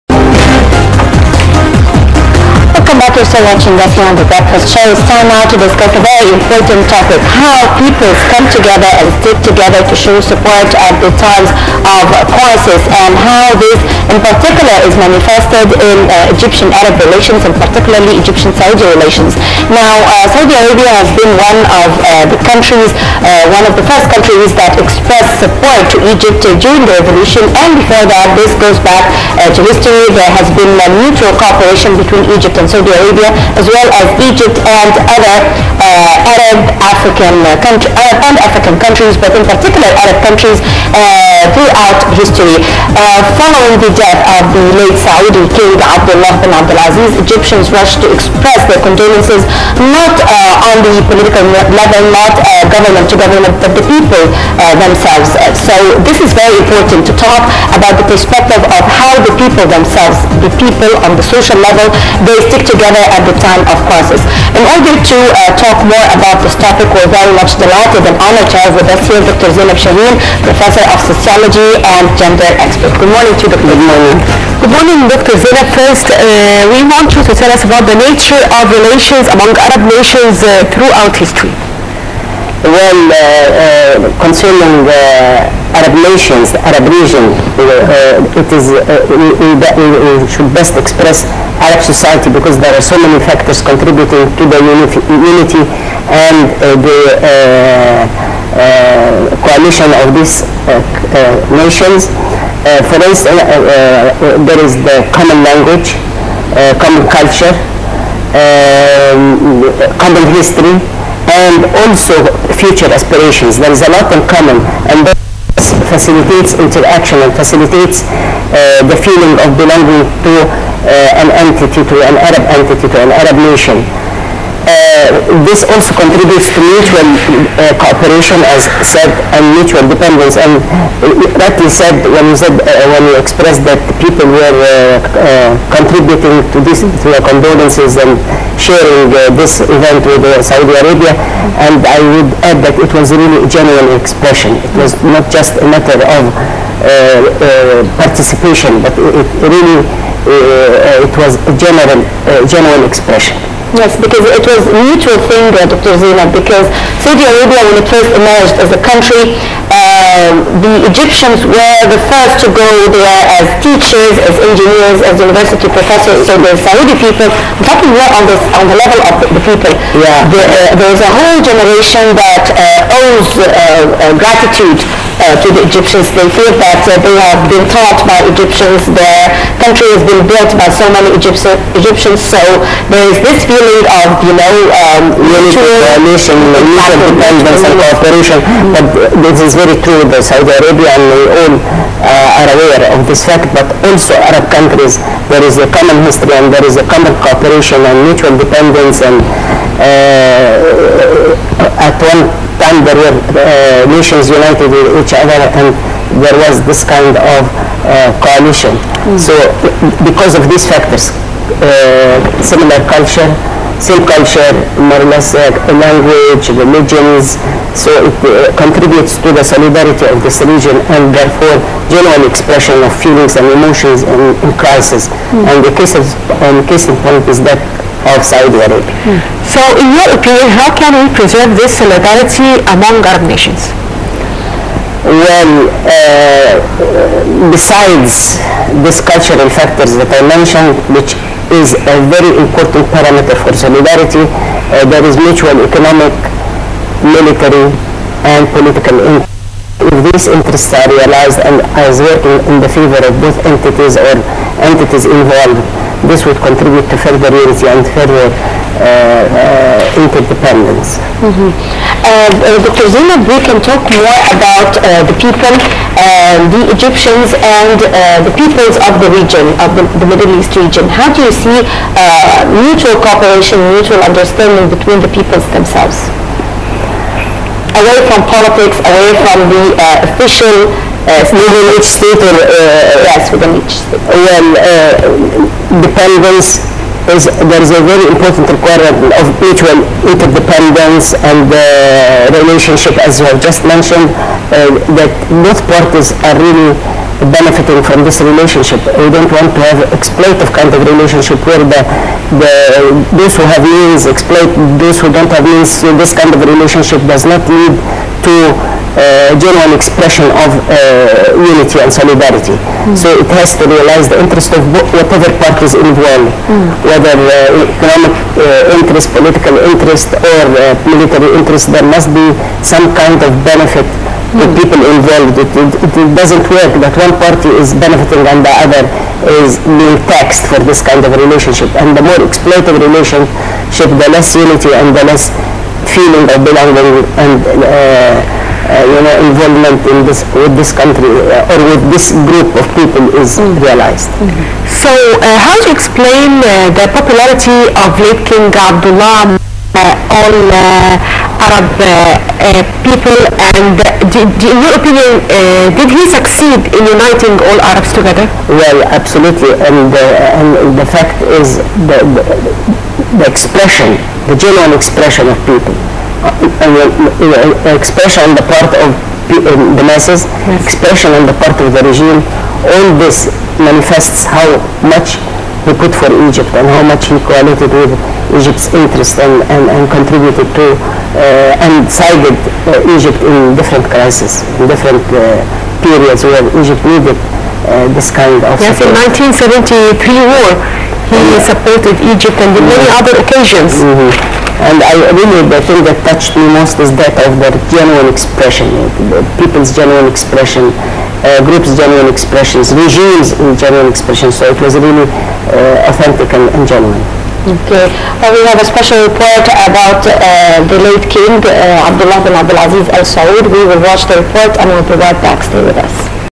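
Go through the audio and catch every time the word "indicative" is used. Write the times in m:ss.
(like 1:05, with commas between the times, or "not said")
not said.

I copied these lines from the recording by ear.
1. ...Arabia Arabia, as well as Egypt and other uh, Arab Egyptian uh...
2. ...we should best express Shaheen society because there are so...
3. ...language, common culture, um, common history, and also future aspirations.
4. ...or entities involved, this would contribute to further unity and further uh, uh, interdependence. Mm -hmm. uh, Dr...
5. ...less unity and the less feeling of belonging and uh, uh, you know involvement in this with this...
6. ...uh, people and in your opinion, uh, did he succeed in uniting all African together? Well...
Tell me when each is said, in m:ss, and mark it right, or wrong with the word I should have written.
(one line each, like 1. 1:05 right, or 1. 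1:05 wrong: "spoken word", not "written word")
1. 0:32 wrong: "African", not "Egyptian"
2. 1:29 wrong: "Arab", not "Shaheen"
3. 1:45 right
4. 4:13 right
5. 5:34 right
6. 5:52 wrong: "Arabs", not "African".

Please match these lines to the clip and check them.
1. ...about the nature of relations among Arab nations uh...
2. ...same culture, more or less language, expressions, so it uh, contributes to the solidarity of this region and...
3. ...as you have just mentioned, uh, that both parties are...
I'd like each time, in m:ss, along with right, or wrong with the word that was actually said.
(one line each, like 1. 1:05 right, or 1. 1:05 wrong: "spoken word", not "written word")
1. 1:17 right
2. 3:33 wrong: "religions", not "expressions"
3. 4:53 right.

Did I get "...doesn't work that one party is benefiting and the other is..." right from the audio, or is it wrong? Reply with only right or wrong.
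right.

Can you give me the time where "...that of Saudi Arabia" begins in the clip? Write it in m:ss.
3:47.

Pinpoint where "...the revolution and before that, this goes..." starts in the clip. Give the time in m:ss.
0:26.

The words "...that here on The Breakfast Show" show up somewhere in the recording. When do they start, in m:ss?
0:03.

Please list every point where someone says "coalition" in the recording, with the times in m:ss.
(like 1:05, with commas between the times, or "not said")
1:39, 3:28.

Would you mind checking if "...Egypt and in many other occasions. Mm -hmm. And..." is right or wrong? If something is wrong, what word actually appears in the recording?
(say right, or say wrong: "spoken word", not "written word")
right.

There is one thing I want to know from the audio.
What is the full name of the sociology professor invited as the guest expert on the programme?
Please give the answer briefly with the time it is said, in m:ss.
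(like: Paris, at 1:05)
Dr. Zeinab Shaheen, at 1:09.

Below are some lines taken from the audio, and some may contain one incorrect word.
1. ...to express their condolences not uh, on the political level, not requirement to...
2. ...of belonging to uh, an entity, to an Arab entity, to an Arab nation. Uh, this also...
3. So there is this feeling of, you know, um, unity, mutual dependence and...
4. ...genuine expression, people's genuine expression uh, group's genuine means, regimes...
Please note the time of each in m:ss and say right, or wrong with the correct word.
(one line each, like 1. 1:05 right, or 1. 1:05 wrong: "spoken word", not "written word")
1. 0:48 wrong: "government", not "requirement"
2. 1:59 right
3. 3:02 right
4. 6:37 wrong: "expressions", not "means".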